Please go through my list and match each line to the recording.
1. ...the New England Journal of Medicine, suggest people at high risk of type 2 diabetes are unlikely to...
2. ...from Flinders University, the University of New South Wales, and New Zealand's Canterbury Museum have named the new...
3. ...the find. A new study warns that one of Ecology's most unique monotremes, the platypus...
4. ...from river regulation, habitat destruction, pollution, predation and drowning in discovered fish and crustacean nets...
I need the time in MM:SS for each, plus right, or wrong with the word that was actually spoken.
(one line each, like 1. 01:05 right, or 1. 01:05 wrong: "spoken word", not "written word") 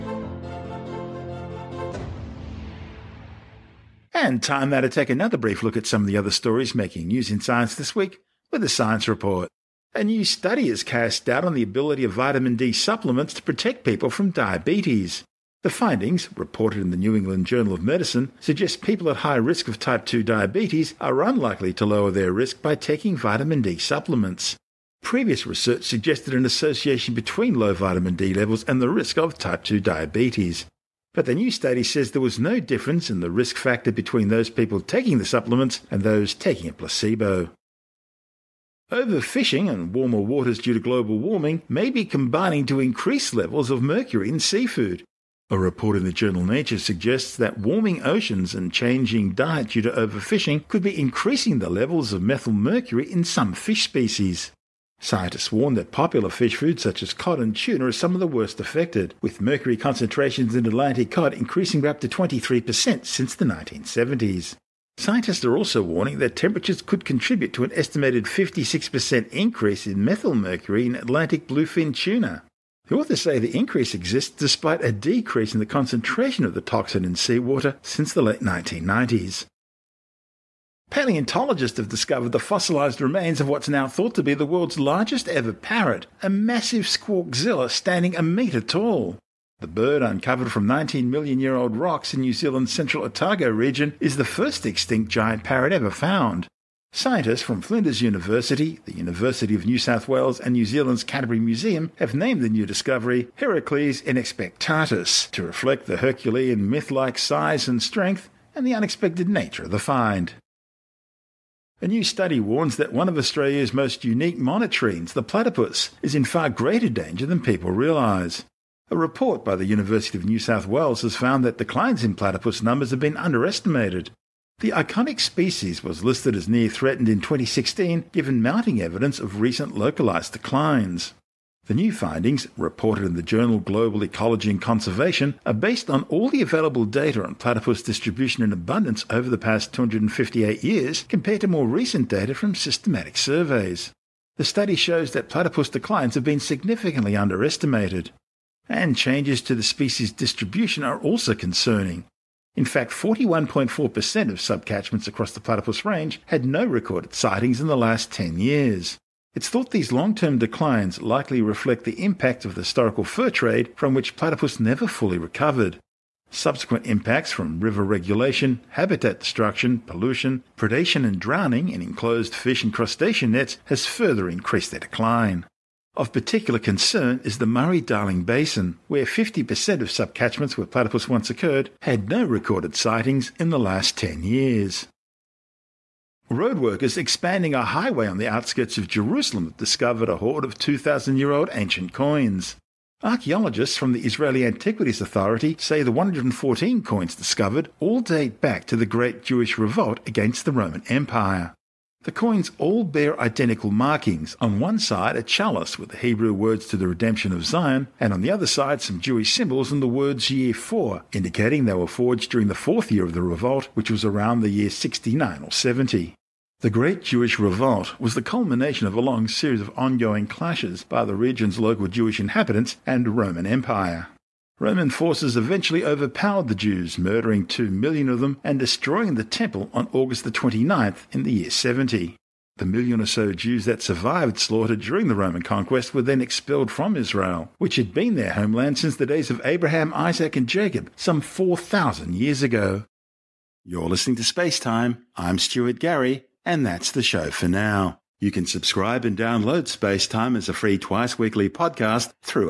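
1. 00:16 right
2. 01:37 right
3. 01:49 wrong: "Australia", not "Ecology"
4. 02:47 wrong: "enclosed", not "discovered".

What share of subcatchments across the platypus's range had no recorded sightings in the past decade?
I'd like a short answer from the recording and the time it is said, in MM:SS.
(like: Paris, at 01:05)
41.4%, at 02:32.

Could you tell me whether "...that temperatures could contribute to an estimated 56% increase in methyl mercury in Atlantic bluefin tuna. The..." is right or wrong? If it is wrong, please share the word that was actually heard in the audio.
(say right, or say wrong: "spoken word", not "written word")
right.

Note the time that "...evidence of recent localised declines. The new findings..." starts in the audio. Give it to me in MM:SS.
02:08.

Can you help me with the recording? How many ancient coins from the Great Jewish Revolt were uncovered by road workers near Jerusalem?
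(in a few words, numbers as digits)
114.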